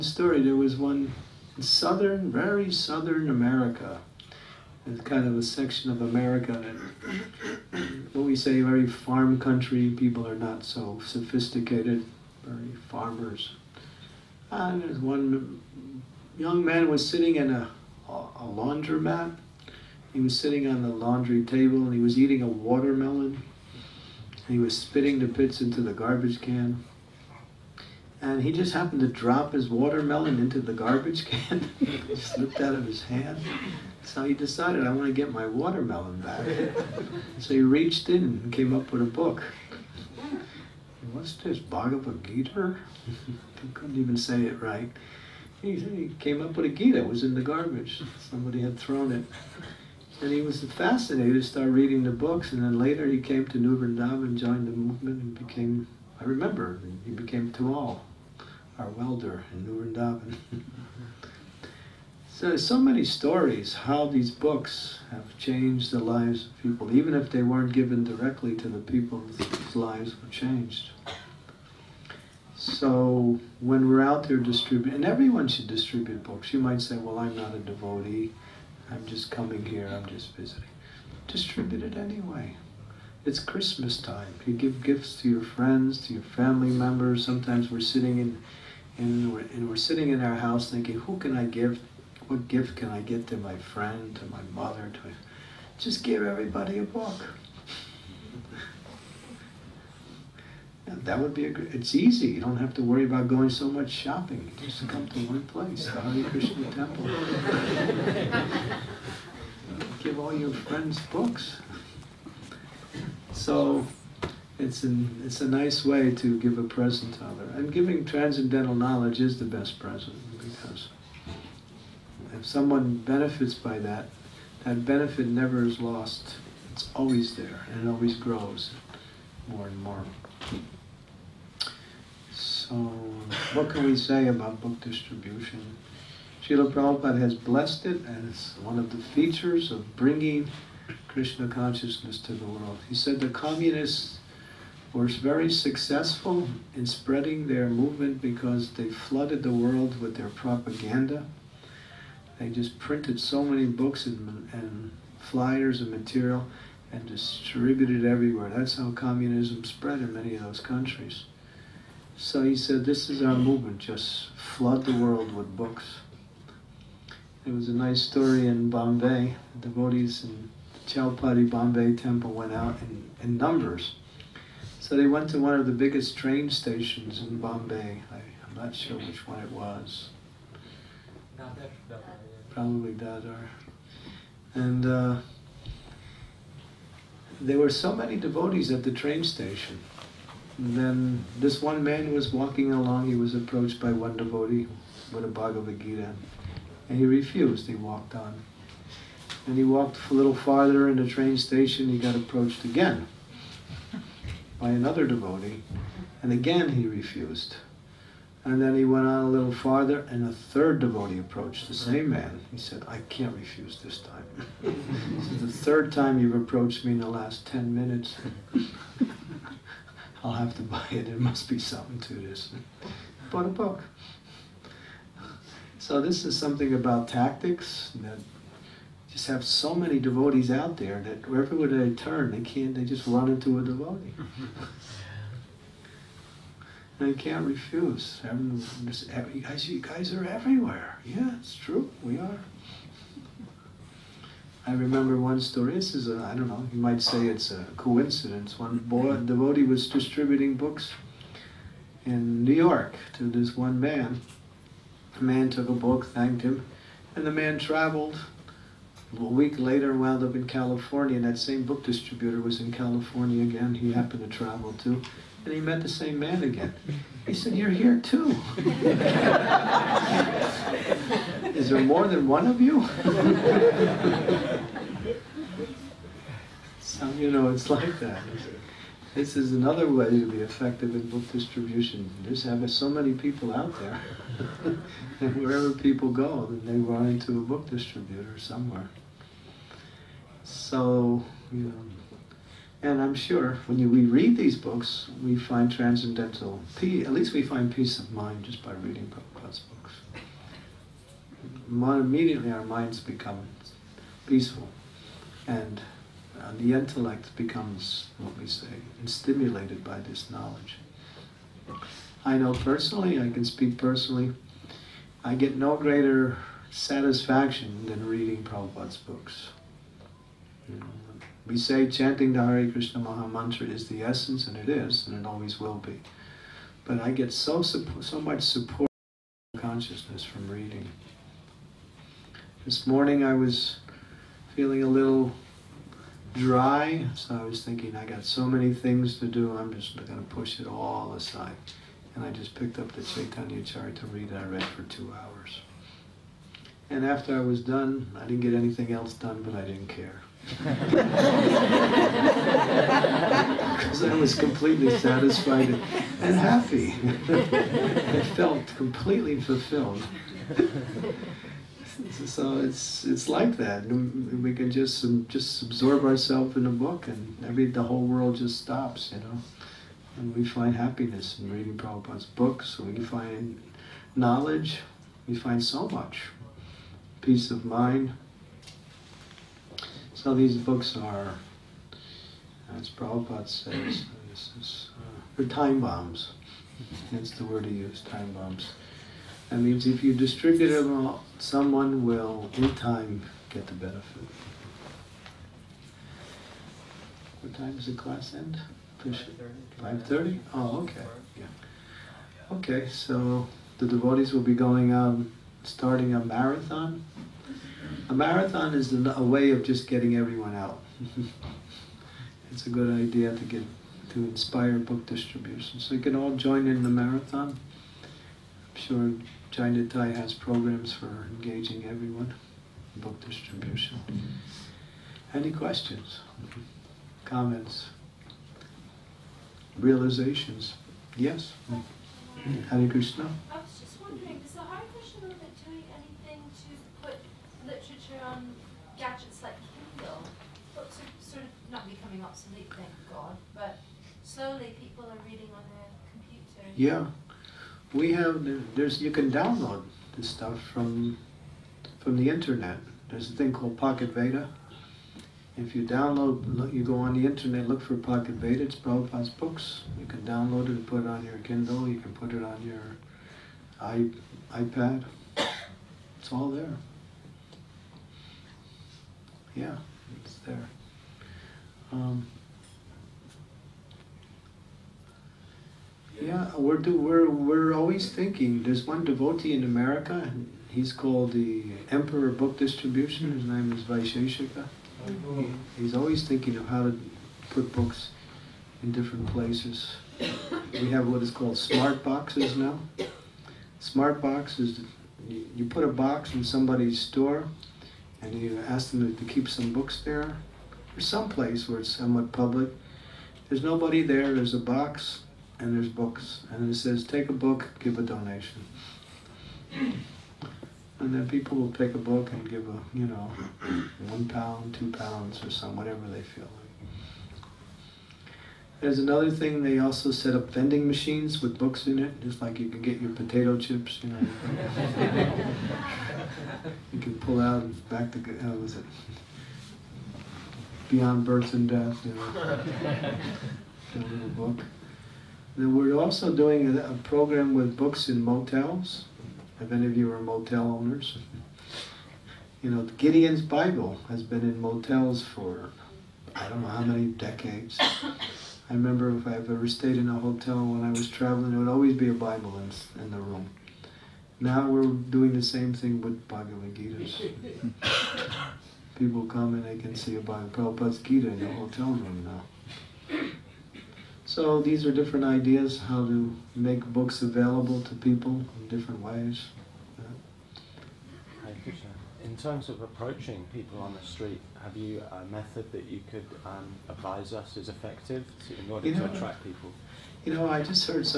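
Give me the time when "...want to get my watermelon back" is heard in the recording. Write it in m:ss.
0:34.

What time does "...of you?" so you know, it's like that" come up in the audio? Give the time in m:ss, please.
4:32.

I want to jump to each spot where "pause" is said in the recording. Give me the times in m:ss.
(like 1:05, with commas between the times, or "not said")
not said.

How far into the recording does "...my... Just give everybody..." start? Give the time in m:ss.
1:35.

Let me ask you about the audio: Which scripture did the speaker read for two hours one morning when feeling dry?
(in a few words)
Chaitanya Charitamrita.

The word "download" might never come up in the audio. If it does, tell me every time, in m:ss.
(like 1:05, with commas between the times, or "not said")
7:29, 7:35, 7:40.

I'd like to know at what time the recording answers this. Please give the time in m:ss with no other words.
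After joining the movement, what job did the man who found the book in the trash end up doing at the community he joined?
0:58.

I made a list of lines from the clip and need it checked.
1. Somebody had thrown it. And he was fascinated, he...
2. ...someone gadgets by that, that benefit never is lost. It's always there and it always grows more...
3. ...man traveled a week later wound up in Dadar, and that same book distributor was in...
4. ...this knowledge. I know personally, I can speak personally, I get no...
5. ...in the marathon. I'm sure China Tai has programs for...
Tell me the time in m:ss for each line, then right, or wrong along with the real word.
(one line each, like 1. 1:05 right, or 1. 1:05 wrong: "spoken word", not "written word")
1. 0:48 right
2. 2:02 wrong: "benefits", not "gadgets"
3. 4:17 wrong: "California", not "Dadar"
4. 5:09 right
5. 6:56 right.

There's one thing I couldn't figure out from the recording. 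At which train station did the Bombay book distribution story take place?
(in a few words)
Dadar.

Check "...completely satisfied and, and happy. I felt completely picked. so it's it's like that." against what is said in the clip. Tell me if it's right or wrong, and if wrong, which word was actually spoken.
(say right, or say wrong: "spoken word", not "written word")
wrong: "fulfilled", not "picked".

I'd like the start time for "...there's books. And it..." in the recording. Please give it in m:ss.
8:25.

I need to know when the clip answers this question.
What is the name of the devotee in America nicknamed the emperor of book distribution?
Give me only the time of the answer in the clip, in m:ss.
8:03.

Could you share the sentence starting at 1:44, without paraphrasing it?
You just come to one place, the Hare Krishna temple.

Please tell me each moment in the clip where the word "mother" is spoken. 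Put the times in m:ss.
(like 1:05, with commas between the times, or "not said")
1:34.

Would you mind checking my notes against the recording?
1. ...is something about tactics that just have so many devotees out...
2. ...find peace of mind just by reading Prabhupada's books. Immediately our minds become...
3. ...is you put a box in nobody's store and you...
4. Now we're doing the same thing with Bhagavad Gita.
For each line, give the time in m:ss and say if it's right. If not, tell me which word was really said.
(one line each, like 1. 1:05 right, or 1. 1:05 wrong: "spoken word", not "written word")
1. 3:46 right
2. 4:57 right
3. 8:14 wrong: "somebody", not "nobody"
4. 9:14 right.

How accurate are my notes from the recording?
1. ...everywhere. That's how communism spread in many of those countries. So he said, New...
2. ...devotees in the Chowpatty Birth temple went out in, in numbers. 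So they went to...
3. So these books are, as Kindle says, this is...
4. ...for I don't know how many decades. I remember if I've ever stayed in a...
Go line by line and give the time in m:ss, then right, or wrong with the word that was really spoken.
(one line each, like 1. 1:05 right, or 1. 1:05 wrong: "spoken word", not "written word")
1. 2:38 wrong: "This", not "New"
2. 2:49 wrong: "Bombay", not "Birth"
3. 6:20 wrong: "Prabhupada", not "Kindle"
4. 9:05 right.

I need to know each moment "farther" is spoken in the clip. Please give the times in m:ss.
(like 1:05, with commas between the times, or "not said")
3:20, 3:29.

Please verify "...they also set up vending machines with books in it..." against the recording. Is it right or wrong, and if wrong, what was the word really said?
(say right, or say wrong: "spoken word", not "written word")
right.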